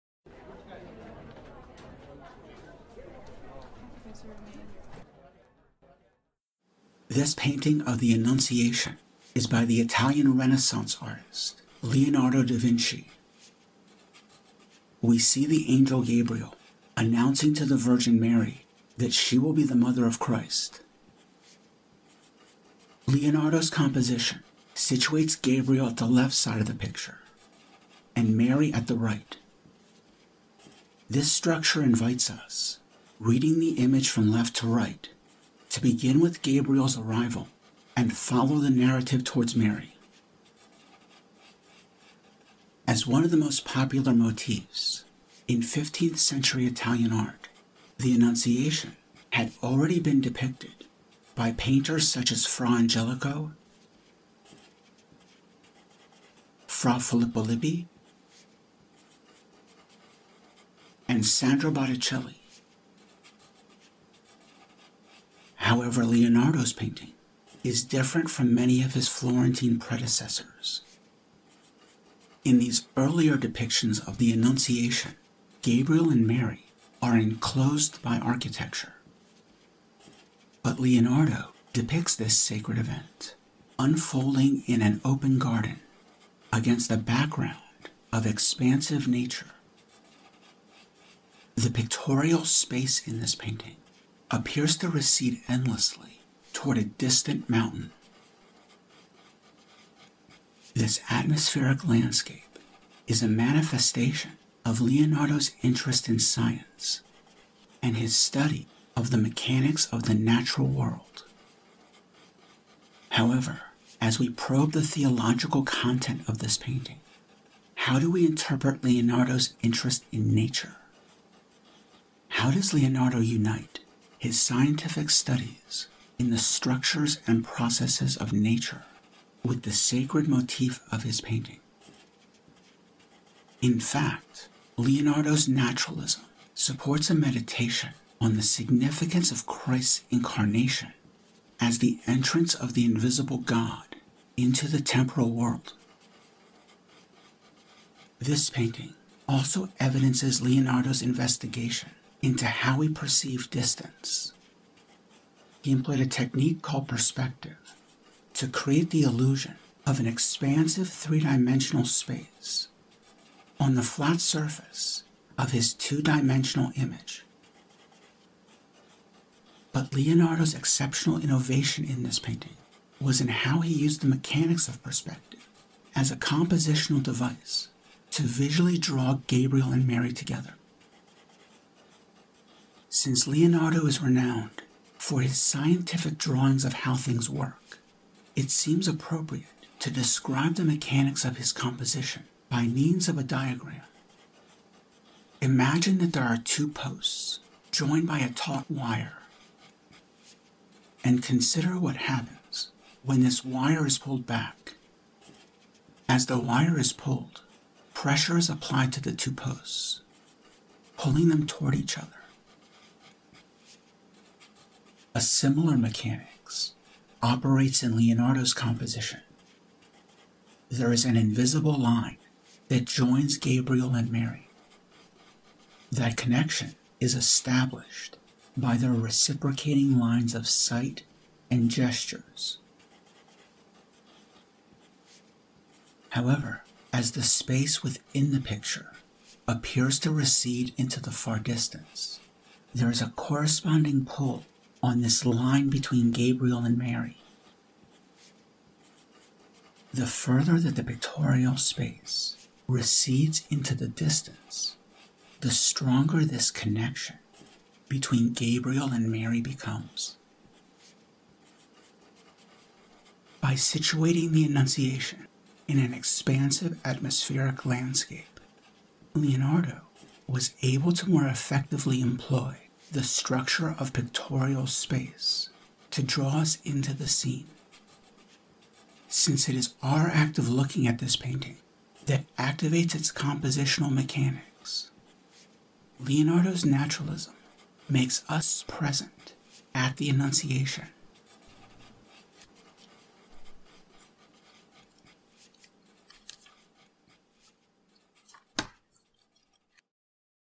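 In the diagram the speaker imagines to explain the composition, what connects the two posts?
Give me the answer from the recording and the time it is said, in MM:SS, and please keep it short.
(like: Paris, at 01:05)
A taut wire, at 03:18.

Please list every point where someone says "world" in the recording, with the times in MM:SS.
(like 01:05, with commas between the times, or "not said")
01:50, 02:25.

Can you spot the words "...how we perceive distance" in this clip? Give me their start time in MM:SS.
02:32.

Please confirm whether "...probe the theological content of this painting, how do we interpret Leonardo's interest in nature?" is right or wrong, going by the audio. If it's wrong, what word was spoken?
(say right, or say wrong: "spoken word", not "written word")
right.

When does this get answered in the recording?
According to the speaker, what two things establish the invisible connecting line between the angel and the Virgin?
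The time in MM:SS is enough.
03:49.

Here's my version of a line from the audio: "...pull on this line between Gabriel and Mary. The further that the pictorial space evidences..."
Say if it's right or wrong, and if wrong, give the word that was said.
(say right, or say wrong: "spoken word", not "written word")
wrong: "recedes", not "evidences".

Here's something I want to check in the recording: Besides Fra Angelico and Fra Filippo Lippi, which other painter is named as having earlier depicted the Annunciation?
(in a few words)
Sandro Botticelli.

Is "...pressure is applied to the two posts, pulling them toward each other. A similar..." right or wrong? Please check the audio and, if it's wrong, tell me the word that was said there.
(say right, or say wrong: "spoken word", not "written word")
right.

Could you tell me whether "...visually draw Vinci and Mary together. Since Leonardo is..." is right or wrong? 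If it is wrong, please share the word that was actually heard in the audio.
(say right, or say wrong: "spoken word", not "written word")
wrong: "Gabriel", not "Vinci".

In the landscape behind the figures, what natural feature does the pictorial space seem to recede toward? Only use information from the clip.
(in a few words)
A distant mountain.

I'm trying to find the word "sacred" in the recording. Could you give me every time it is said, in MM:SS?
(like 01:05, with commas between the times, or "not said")
01:22, 02:09.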